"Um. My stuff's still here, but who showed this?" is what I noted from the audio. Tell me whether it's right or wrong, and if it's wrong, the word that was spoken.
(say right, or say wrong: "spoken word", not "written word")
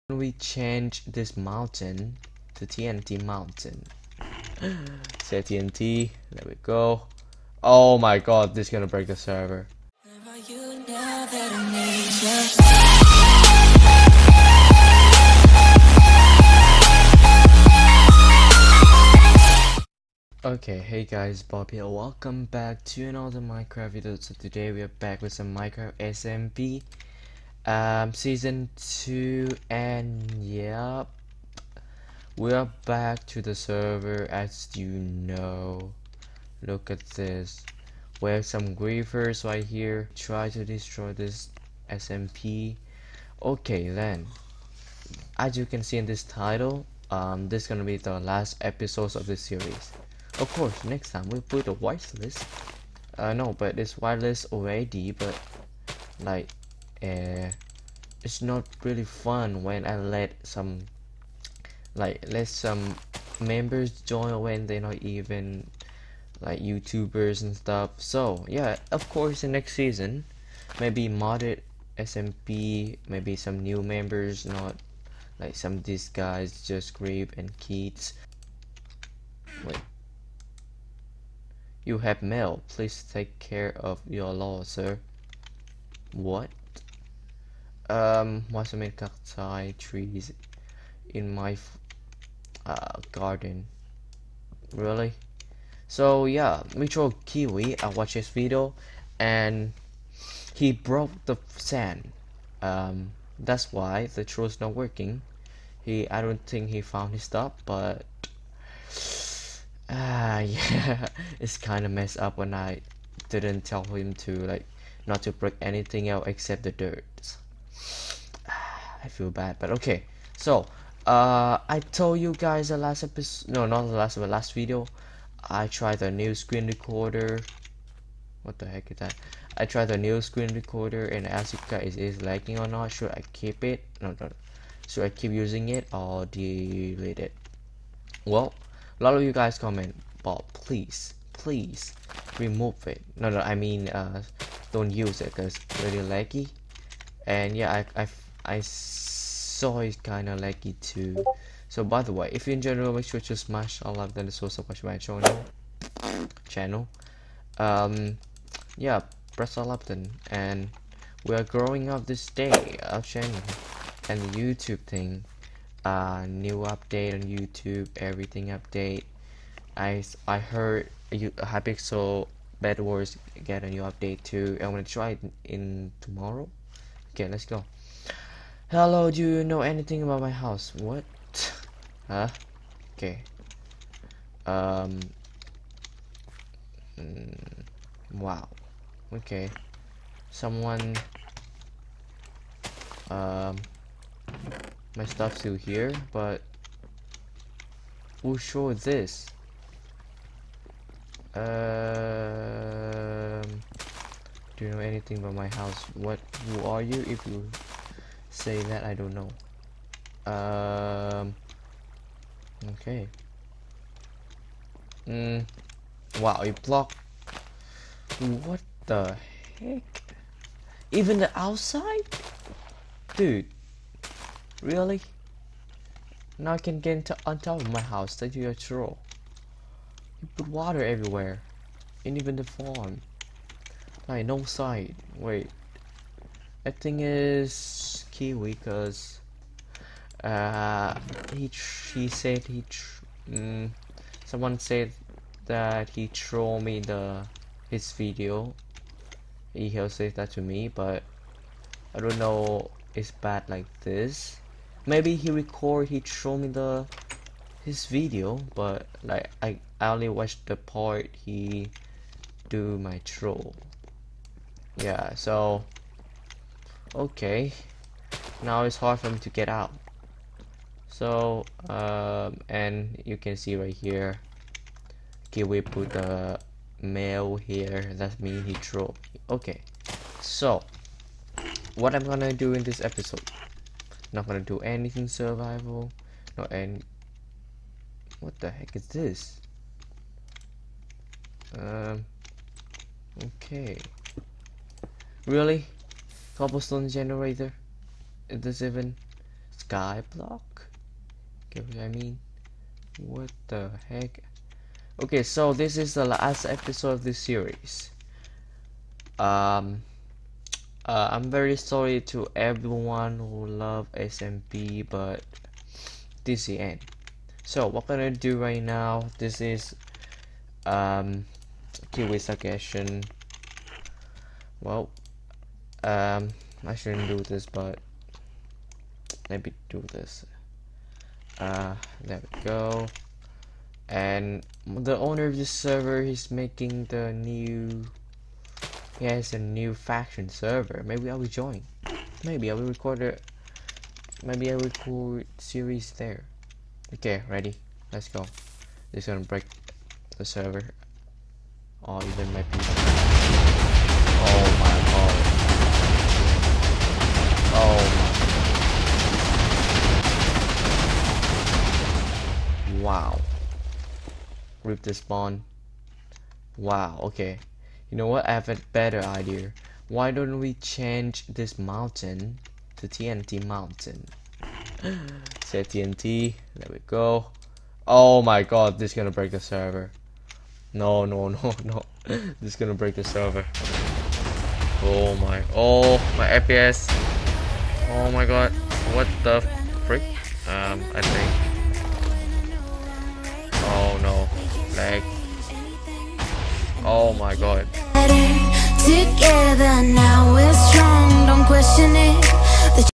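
right.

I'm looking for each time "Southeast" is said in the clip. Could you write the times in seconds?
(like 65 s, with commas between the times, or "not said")
not said.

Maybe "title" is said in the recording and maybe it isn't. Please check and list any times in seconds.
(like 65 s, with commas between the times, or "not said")
46 s.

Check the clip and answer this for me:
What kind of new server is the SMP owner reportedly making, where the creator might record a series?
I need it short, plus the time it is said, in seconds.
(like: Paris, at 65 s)
faction server, at 339 s.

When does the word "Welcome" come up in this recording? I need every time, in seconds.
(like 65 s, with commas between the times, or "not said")
21 s.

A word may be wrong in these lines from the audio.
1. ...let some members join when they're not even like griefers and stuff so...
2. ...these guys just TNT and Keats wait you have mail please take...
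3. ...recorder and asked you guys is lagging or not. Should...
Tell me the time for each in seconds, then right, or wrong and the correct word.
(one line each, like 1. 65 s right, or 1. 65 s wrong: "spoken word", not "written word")
1. 62 s wrong: "youtubers", not "griefers"
2. 75 s wrong: "Grape", not "TNT"
3. 130 s right.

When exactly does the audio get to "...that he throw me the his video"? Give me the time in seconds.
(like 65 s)
245 s.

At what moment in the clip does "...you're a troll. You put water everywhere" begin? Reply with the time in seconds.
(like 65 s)
228 s.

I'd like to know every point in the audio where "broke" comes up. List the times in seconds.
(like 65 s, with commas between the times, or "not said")
100 s.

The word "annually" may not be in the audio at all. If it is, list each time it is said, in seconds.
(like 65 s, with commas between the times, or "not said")
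not said.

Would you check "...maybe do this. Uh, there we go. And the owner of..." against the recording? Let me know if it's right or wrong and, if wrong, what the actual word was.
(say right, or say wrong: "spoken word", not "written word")
right.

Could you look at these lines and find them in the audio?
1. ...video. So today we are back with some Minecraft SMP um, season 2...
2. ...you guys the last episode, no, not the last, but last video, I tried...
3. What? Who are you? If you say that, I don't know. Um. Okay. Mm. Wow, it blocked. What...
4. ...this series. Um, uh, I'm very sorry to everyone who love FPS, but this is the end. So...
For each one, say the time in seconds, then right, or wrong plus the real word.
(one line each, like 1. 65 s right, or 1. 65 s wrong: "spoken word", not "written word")
1. 23 s right
2. 122 s right
3. 205 s right
4. 307 s wrong: "SMP", not "FPS".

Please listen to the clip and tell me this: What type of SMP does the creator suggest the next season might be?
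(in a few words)
modded SMP.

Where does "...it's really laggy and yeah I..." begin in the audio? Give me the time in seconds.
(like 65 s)
145 s.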